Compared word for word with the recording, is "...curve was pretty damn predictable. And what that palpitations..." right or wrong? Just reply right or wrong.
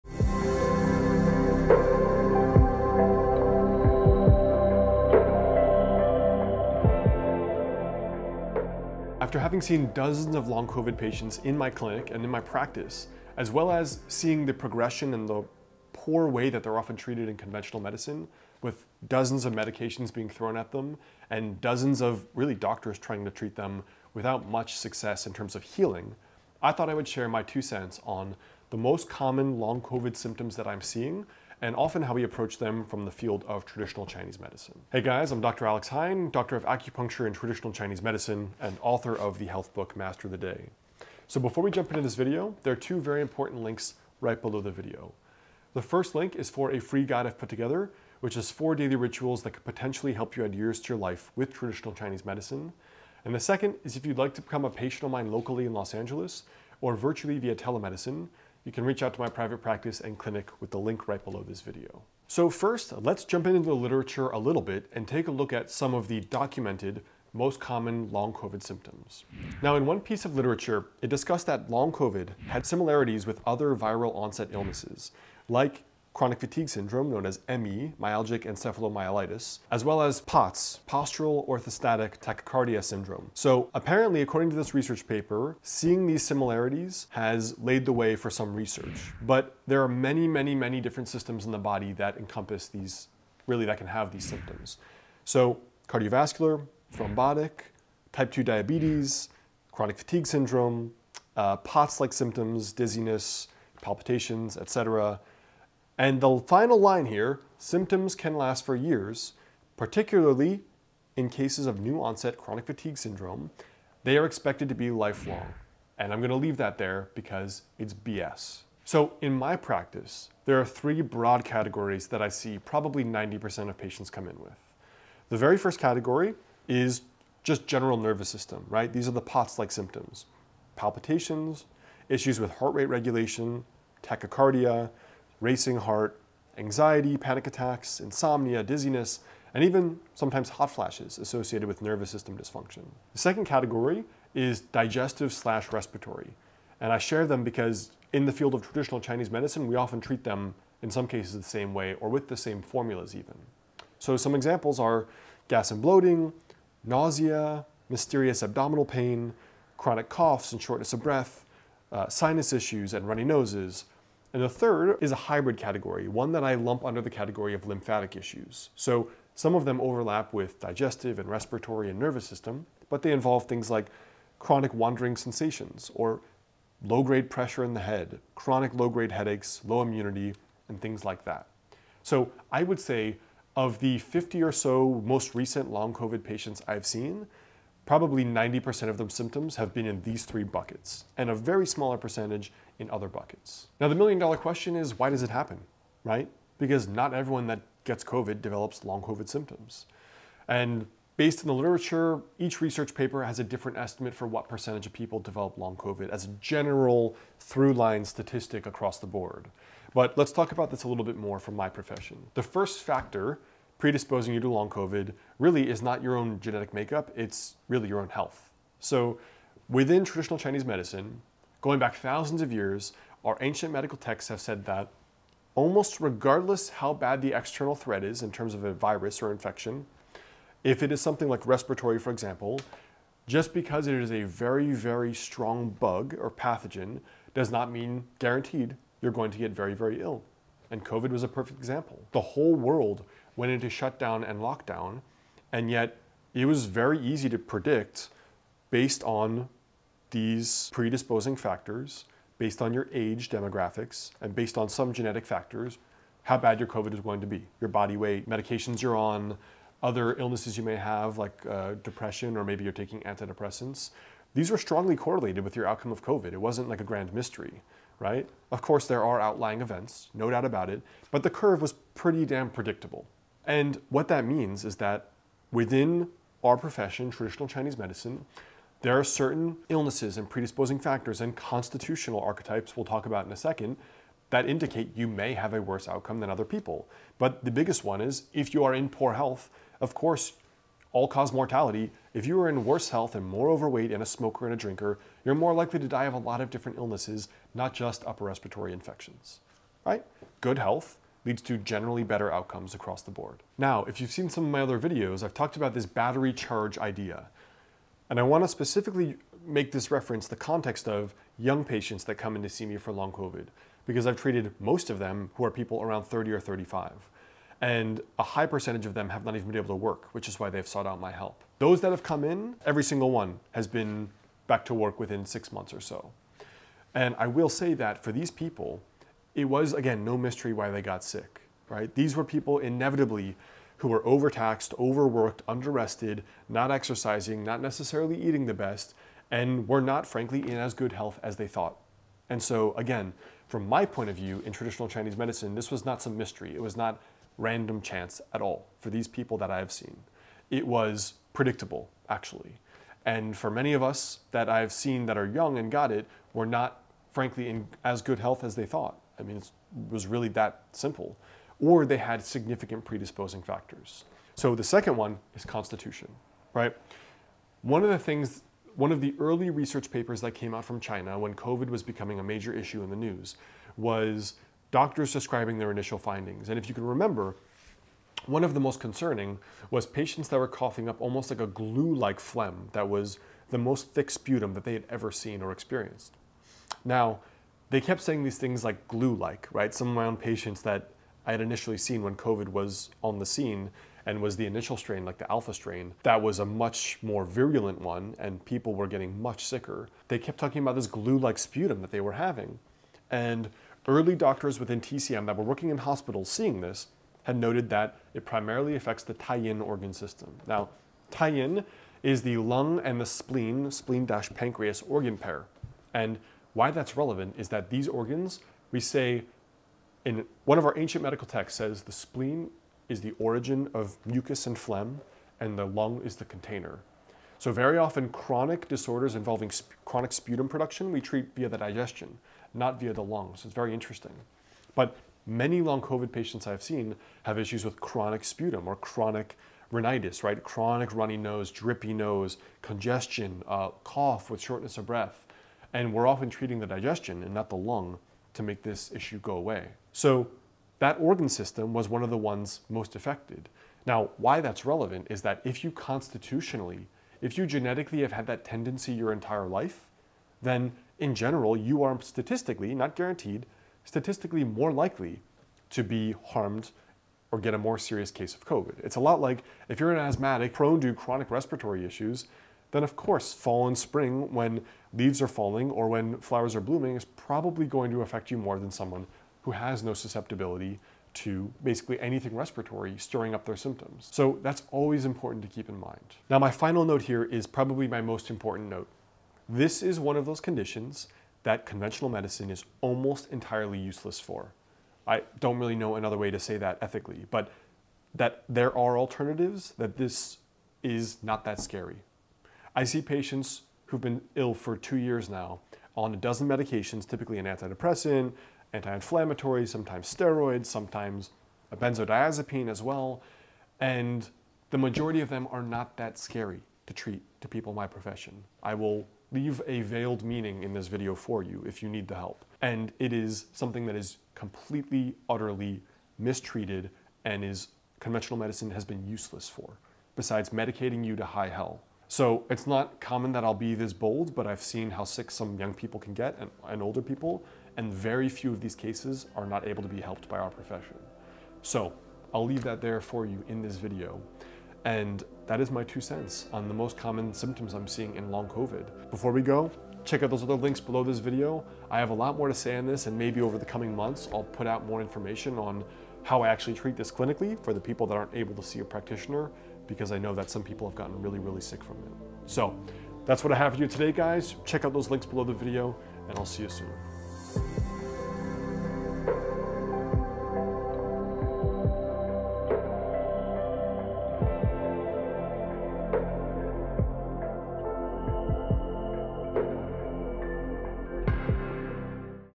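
wrong.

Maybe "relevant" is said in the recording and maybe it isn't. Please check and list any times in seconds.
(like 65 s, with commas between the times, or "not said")
416 s, 454 s.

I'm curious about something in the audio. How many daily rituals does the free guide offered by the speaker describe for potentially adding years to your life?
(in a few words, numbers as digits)
4.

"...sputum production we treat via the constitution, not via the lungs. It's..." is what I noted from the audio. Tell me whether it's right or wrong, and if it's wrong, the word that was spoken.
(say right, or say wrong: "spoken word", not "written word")
wrong: "digestion", not "constitution".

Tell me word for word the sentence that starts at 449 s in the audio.
So that organ system was one of the ones most affected.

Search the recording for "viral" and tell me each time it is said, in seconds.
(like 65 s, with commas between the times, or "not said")
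73 s.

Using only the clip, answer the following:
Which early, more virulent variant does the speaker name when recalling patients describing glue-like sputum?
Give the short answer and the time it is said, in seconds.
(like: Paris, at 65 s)
alpha strain, at 395 s.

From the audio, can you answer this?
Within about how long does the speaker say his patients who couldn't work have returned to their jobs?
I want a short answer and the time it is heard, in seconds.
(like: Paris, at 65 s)
6 months, at 325 s.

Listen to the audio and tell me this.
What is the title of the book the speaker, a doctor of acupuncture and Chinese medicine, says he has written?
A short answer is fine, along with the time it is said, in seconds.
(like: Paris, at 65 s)
Master the Day, at 39 s.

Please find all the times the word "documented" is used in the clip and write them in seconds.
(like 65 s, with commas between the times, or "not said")
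66 s.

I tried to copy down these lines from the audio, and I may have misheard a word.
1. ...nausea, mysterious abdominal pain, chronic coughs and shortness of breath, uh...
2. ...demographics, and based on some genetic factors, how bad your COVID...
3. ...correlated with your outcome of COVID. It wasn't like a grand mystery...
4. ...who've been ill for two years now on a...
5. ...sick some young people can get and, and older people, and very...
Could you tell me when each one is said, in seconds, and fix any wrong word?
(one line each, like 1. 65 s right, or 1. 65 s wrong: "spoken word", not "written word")
1. 156 s right
2. 253 s right
3. 264 s right
4. 503 s right
5. 535 s right.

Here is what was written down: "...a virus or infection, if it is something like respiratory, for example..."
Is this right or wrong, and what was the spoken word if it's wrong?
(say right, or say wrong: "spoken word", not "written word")
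right.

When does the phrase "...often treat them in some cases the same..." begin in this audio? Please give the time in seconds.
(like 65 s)
149 s.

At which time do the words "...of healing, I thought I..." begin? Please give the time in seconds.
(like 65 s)
25 s.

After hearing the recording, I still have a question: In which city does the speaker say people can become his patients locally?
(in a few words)
Los Angeles.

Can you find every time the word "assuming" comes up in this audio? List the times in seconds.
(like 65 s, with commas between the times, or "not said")
not said.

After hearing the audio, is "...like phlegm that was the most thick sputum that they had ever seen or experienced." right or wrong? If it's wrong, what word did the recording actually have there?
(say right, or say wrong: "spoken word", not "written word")
right.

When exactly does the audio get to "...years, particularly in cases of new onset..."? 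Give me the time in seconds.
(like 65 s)
108 s.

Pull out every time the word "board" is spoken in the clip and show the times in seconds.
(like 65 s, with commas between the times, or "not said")
209 s, 303 s.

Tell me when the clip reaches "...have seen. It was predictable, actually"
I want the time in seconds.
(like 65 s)
349 s.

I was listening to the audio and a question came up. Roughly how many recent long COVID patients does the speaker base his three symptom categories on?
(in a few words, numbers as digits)
50.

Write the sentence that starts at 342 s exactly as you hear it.
And so, again, from my point of view in traditional Chinese medicine, this was not some mystery.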